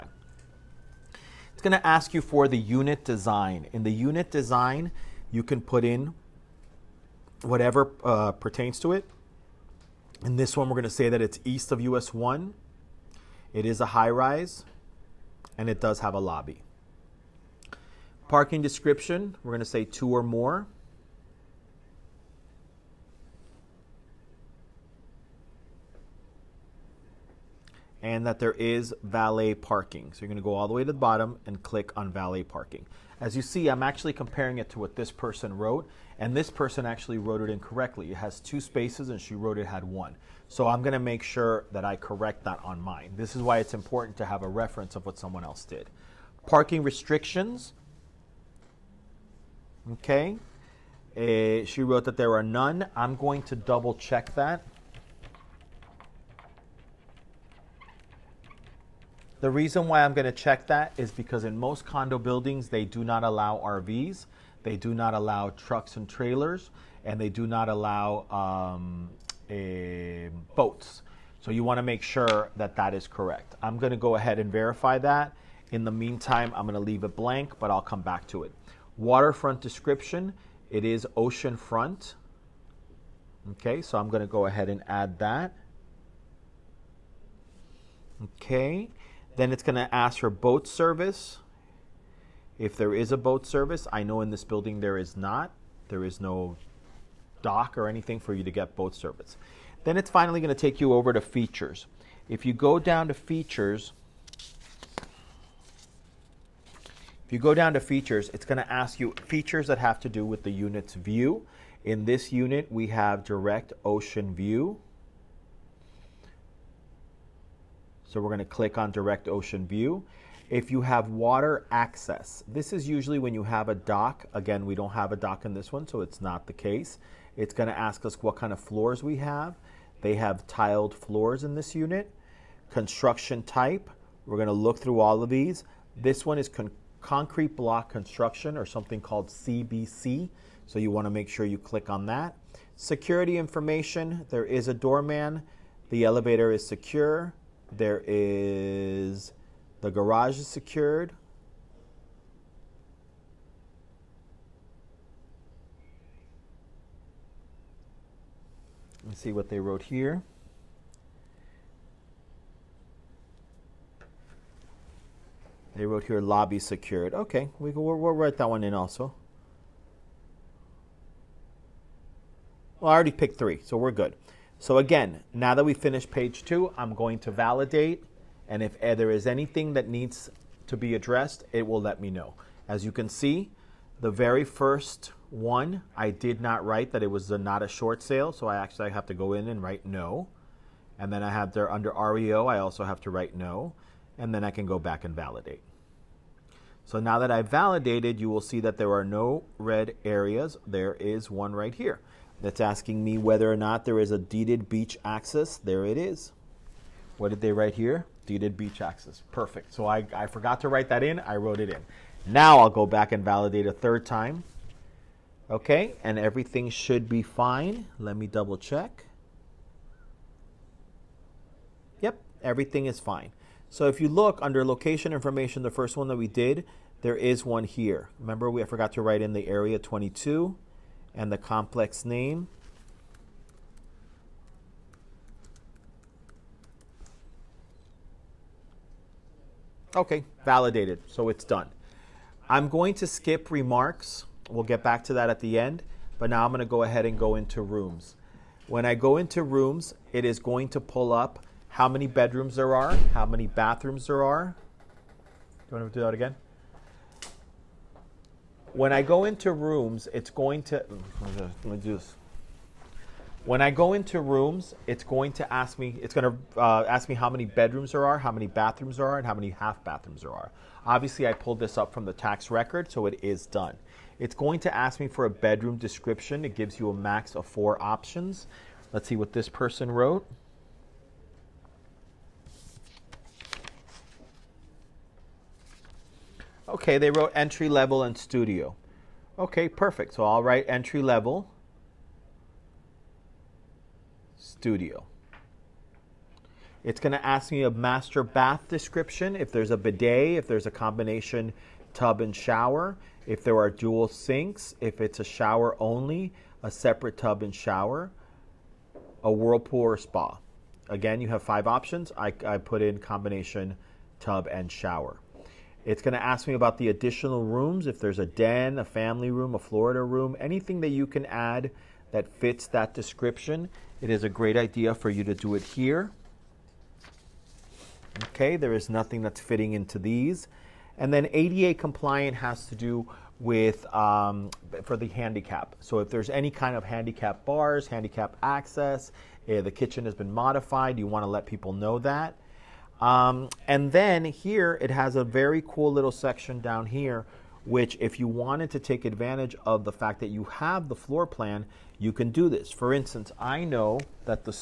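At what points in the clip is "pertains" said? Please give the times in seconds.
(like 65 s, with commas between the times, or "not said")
8 s.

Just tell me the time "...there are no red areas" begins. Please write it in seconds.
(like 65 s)
198 s.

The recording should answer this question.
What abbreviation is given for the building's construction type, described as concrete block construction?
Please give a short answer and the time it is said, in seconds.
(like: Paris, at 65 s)
CBC, at 139 s.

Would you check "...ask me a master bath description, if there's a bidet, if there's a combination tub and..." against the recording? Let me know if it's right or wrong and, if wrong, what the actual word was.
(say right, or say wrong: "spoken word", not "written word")
right.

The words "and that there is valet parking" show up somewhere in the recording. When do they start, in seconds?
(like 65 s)
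28 s.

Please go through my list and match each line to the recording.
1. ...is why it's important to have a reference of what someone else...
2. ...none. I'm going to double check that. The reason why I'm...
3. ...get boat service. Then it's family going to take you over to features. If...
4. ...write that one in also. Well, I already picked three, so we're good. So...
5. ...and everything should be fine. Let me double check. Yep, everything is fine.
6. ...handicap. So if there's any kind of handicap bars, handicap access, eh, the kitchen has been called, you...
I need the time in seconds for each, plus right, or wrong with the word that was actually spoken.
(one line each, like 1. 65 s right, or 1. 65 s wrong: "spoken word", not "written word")
1. 43 s right
2. 52 s right
3. 98 s wrong: "finally", not "family"
4. 168 s right
5. 216 s right
6. 335 s wrong: "modified", not "called".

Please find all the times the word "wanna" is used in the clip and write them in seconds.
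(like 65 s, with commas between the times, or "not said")
255 s.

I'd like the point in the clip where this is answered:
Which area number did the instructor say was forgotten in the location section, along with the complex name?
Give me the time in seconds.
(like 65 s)
229 s.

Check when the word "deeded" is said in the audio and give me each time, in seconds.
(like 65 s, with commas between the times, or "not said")
204 s, 208 s.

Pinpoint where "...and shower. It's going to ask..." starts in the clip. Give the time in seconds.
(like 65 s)
314 s.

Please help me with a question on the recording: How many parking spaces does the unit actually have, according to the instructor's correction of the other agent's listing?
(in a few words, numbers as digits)
2.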